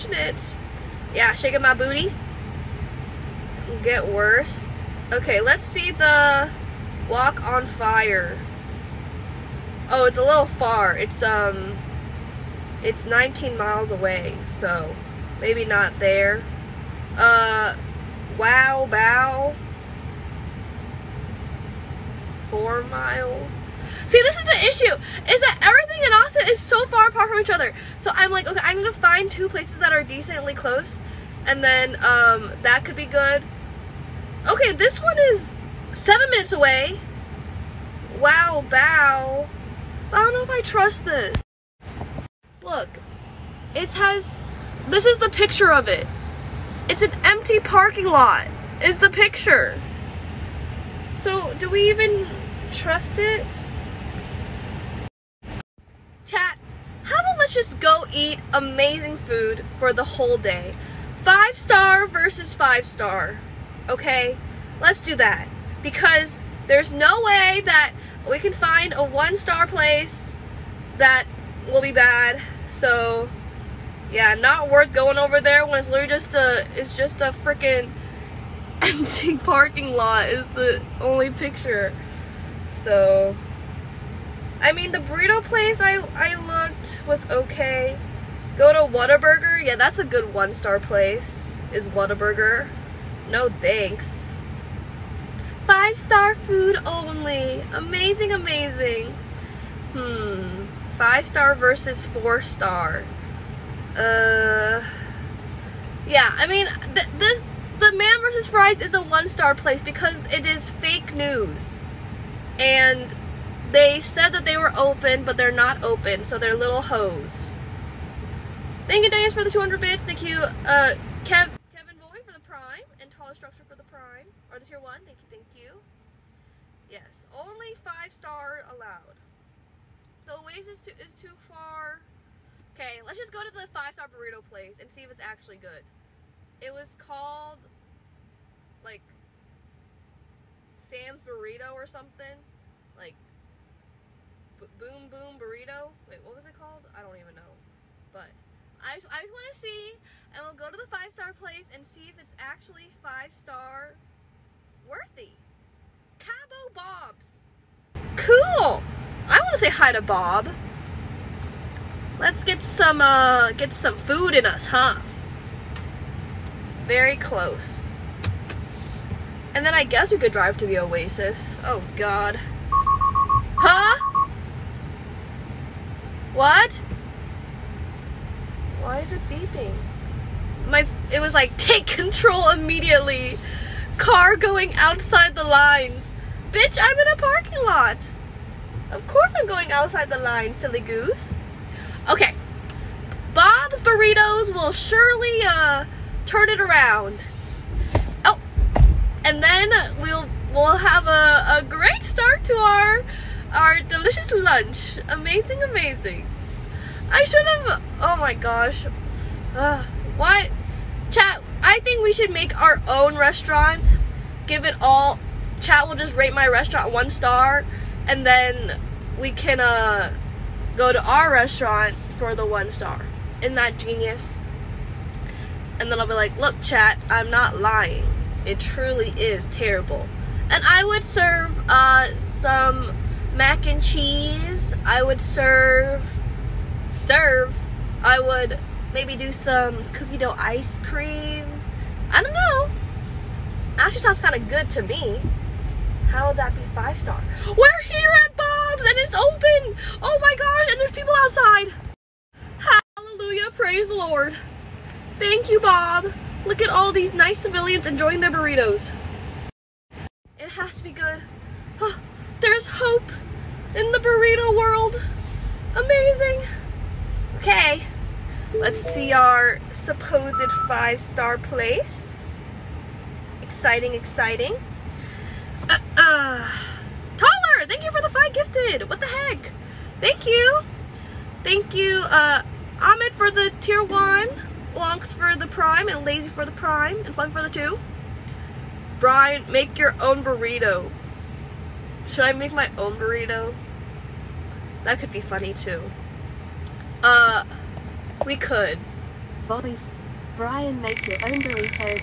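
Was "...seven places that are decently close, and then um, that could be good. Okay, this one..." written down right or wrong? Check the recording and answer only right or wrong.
wrong.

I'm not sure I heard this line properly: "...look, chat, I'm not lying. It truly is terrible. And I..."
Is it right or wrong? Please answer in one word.
right.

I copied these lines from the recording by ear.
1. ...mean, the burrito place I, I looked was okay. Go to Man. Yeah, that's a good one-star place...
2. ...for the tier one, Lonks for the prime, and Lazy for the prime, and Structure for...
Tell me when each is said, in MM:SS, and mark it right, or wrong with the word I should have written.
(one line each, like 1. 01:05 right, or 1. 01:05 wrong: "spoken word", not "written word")
1. 01:24 wrong: "Whataburger", not "Man"
2. 04:43 wrong: "Fun", not "Structure".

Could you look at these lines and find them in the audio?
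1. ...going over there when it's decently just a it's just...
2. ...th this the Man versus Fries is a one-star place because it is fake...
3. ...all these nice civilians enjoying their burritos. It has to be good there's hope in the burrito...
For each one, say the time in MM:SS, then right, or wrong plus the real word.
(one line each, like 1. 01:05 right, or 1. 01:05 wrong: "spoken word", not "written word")
1. 01:14 wrong: "literally", not "decently"
2. 01:46 right
3. 04:16 right.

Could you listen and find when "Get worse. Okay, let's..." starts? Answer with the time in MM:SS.
00:03.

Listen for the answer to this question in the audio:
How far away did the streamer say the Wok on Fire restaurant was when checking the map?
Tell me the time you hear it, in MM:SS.
00:13.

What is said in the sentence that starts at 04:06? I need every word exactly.
How would that be five star?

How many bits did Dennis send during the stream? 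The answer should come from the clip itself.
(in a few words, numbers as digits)
200.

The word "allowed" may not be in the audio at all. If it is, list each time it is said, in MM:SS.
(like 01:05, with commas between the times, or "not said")
02:08.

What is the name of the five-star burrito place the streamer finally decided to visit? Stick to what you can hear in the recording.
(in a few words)
Cabo Bob's.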